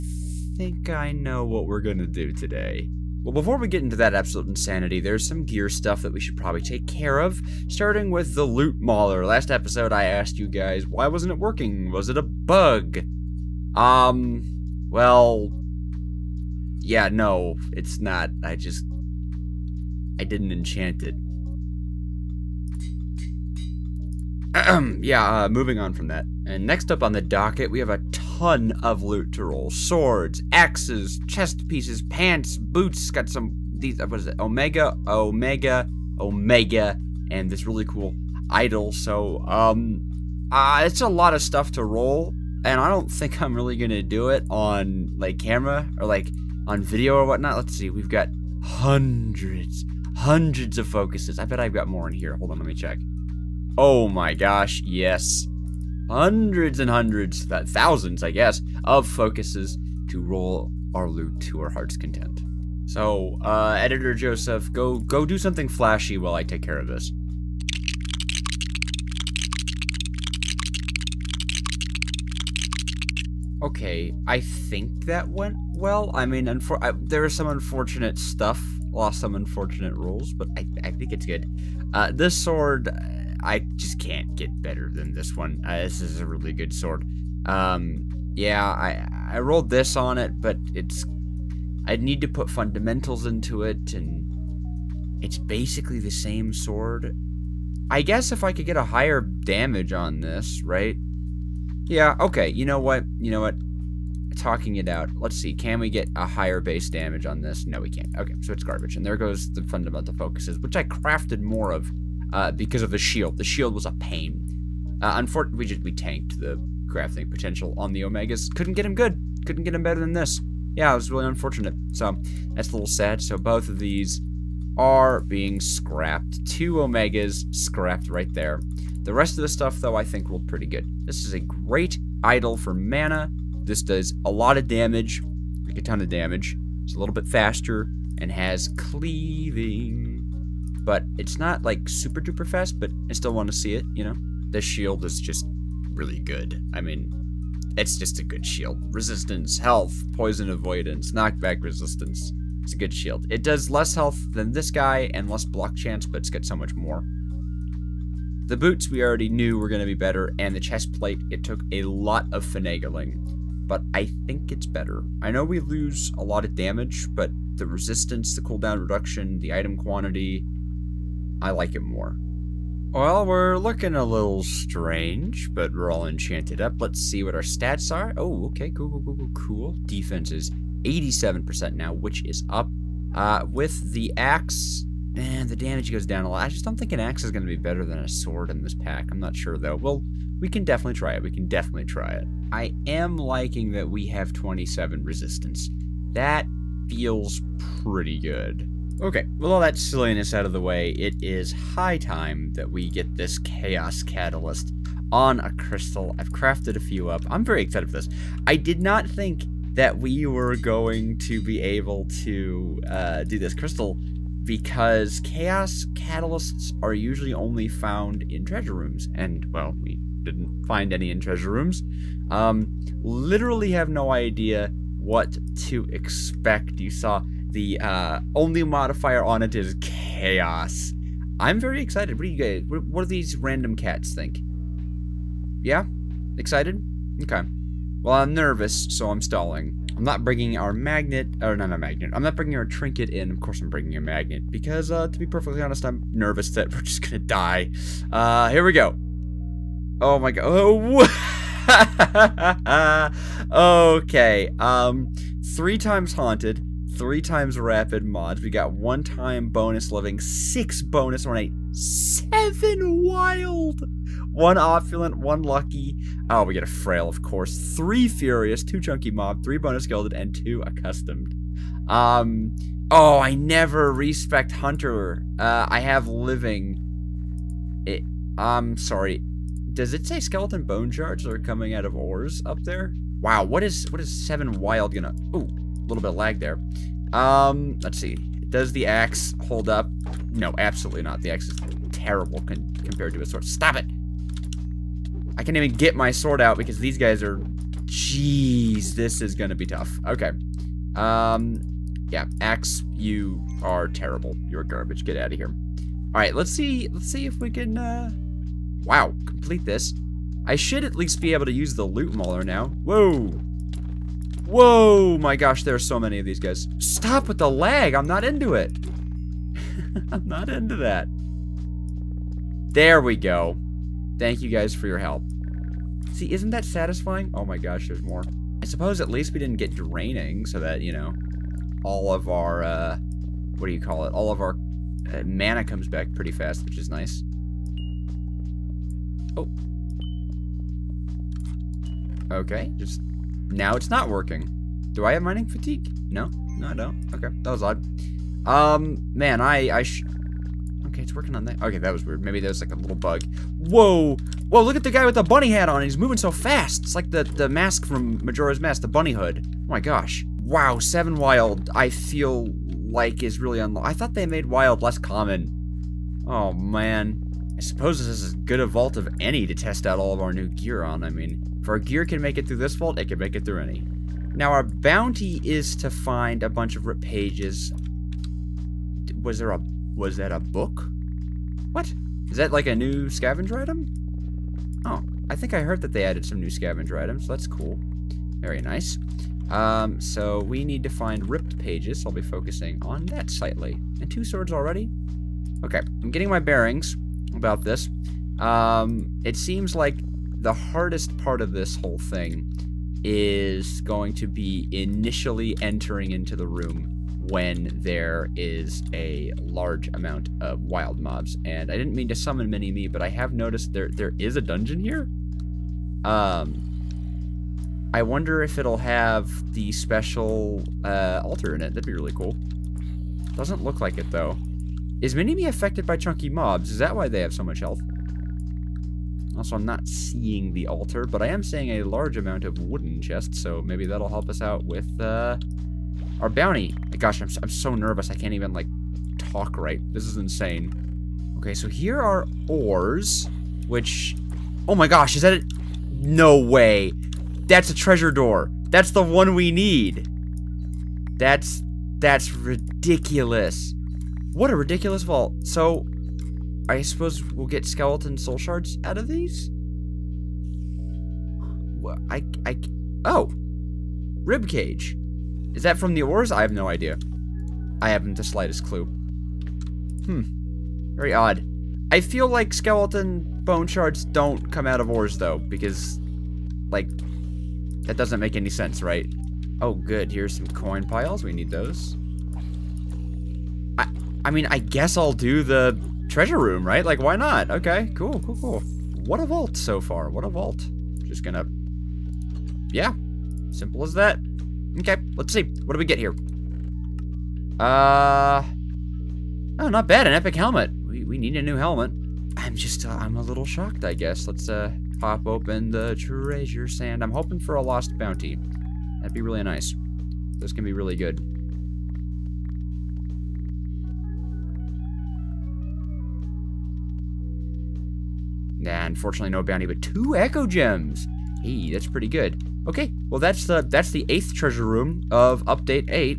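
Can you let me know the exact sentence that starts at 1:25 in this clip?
Uh, this is a really good sword.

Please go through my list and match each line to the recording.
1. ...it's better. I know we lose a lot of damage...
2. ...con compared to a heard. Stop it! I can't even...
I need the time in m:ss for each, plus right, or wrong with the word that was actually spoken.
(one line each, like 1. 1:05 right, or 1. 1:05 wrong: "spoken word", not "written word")
1. 2:44 right
2. 4:52 wrong: "sword", not "heard".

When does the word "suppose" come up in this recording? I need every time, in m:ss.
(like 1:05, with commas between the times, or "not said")
5:28, 6:07, 7:36.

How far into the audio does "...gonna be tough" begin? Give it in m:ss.
4:59.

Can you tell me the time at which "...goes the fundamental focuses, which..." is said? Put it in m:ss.
1:49.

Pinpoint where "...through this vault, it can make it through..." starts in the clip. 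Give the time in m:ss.
6:12.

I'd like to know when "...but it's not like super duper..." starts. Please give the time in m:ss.
2:20.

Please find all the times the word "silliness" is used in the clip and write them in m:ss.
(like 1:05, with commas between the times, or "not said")
3:19.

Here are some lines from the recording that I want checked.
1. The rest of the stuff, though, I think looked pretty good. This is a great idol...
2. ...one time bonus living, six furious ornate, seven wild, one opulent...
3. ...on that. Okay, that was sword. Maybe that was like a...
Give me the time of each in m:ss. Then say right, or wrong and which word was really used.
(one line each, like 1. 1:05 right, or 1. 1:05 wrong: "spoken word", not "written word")
1. 2:09 right
2. 4:18 wrong: "bonus", not "furious"
3. 5:51 wrong: "weird", not "sword".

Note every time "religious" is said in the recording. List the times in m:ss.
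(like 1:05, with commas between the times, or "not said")
not said.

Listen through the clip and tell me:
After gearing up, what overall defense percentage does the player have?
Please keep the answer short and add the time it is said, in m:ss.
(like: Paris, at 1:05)
87%, at 3:00.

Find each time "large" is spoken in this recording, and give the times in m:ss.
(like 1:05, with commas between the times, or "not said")
6:49, 7:11.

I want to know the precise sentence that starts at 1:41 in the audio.
Yeah, okay, you know what, you know what, talking it out.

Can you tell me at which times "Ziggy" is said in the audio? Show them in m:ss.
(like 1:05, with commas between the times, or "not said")
not said.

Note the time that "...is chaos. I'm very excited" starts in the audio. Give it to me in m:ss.
3:49.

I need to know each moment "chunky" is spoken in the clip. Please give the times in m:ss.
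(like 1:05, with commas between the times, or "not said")
4:28, 7:05.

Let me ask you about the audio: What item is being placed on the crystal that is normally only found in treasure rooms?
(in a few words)
Chaos Catalyst.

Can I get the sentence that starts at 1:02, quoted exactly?
So, uh, Editor Joseph, go go do something flashy while I take care of this.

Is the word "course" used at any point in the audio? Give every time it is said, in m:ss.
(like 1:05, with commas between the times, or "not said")
4:03, 4:27.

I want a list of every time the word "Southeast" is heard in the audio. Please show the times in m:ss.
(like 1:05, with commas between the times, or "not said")
not said.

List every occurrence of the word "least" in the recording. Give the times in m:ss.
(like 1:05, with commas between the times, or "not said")
5:10, 5:29.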